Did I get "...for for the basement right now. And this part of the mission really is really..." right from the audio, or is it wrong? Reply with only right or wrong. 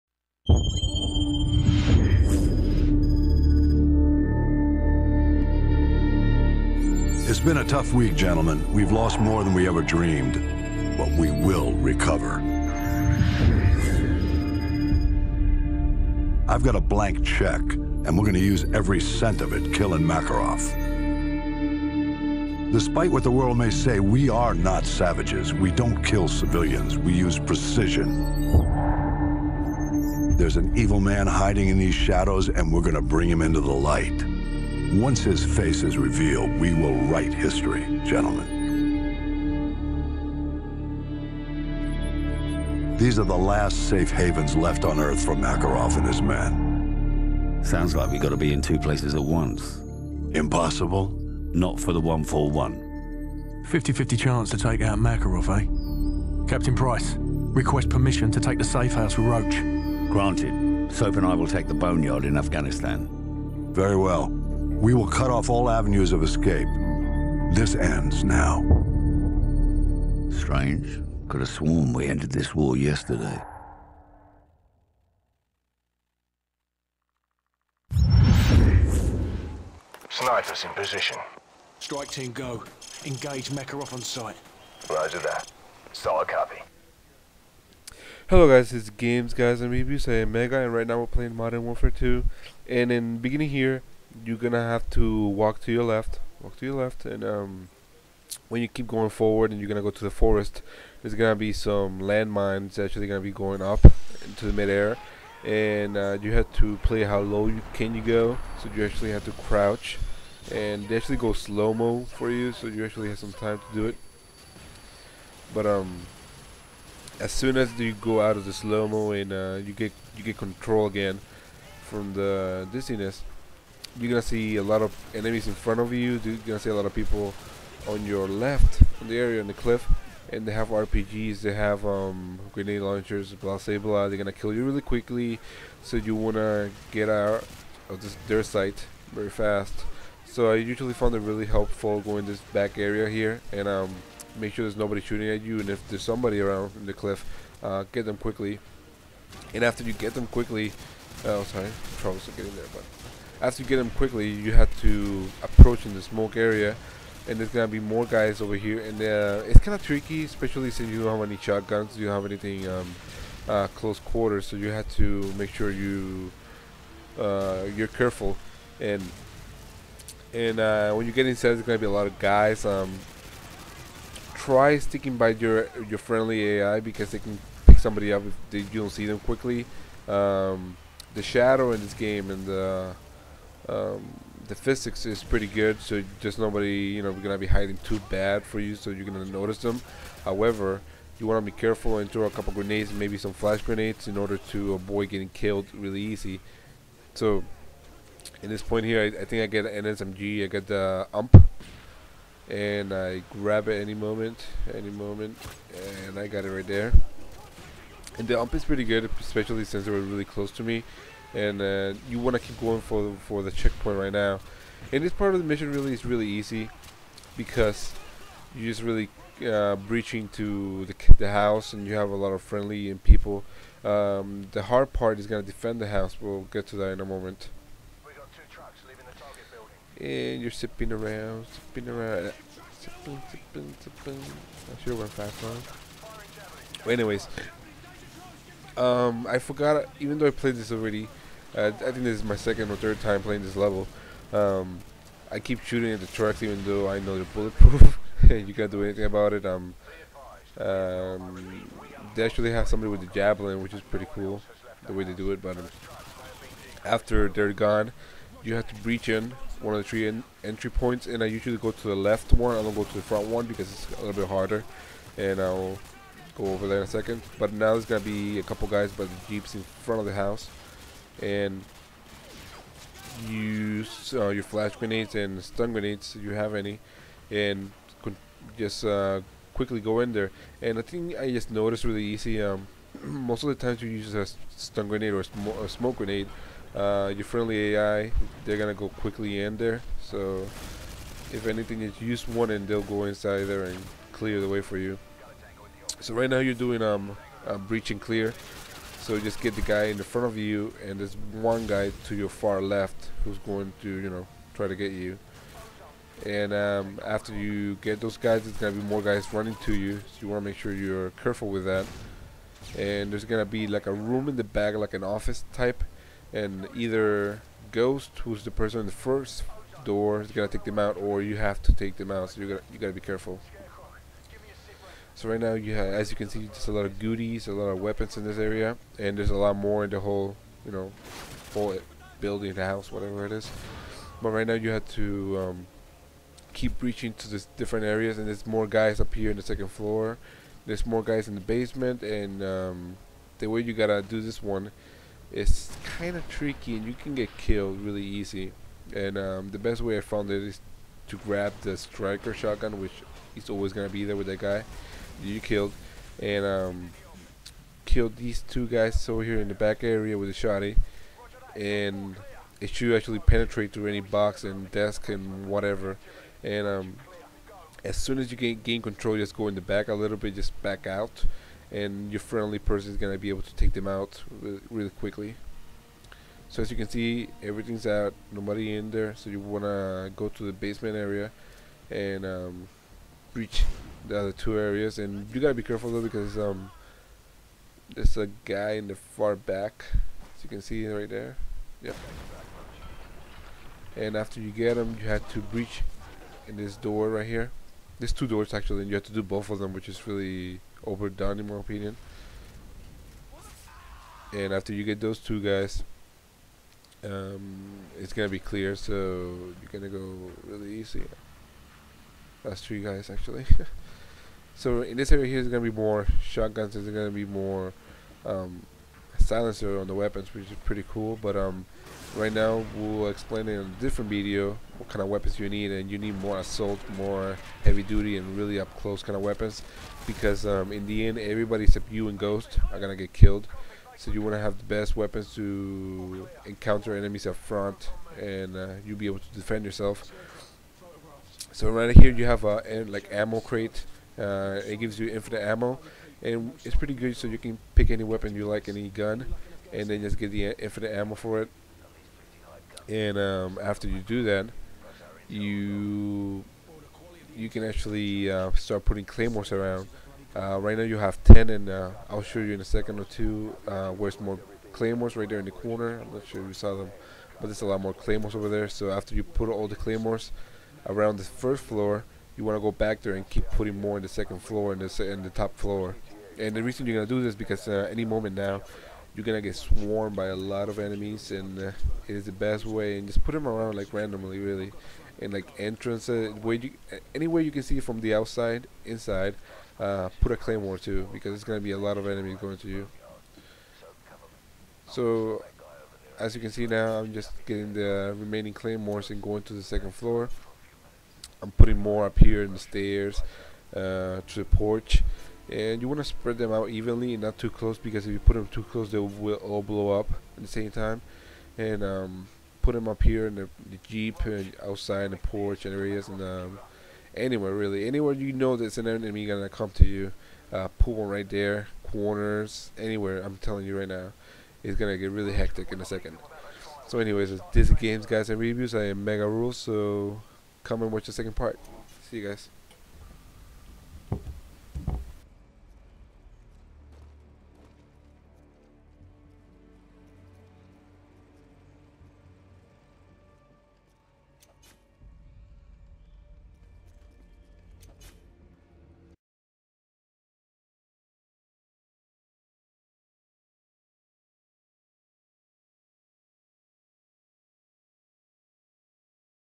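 wrong.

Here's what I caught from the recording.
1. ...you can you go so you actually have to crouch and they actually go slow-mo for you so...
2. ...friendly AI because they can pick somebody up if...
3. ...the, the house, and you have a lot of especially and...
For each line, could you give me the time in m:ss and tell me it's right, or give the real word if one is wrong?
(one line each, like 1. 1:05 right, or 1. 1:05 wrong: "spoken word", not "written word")
1. 1:47 right
2. 2:55 right
3. 3:40 wrong: "friendly", not "especially".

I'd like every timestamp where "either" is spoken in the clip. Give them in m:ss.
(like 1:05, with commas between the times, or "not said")
5:16.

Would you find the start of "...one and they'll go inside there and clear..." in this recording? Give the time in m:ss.
4:52.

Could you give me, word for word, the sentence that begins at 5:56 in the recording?
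And um, kill these two guys over here in the back area with a shotty.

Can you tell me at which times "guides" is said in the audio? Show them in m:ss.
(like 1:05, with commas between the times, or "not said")
1:29, 8:48.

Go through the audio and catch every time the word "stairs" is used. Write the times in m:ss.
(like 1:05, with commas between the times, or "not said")
8:22.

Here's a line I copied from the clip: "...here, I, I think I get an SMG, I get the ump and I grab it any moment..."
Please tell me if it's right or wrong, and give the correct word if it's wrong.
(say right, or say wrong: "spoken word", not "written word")
right.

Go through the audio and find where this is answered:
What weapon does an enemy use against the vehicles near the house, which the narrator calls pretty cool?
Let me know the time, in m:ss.
4:13.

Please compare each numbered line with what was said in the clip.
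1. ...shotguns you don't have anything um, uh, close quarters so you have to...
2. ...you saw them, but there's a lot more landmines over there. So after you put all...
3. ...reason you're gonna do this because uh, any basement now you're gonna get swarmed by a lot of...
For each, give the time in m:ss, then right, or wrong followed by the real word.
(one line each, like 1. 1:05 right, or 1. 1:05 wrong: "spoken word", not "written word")
1. 2:41 right
2. 7:46 wrong: "claymores", not "landmines"
3. 7:56 wrong: "moment", not "basement".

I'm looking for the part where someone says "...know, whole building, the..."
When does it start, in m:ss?
5:30.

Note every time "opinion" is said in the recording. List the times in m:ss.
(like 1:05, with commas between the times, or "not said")
6:41.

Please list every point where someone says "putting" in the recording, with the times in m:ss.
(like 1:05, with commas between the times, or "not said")
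7:38, 7:53, 8:21.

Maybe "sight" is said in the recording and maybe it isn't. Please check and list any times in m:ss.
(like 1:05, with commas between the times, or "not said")
1:24, 2:18.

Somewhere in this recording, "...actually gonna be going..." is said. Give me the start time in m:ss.
1:42.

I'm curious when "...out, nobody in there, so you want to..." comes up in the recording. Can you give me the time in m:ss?
6:17.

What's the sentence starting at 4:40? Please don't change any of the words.
And I think I just noticed really easy.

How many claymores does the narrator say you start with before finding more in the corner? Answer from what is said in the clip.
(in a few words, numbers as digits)
10.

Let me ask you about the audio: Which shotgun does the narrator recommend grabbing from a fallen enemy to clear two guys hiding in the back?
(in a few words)
Striker.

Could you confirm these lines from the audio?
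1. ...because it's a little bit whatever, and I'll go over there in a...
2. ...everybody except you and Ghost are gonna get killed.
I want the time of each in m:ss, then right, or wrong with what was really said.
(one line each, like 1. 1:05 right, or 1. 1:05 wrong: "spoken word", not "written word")
1. 4:23 wrong: "harder", not "whatever"
2. 7:11 right.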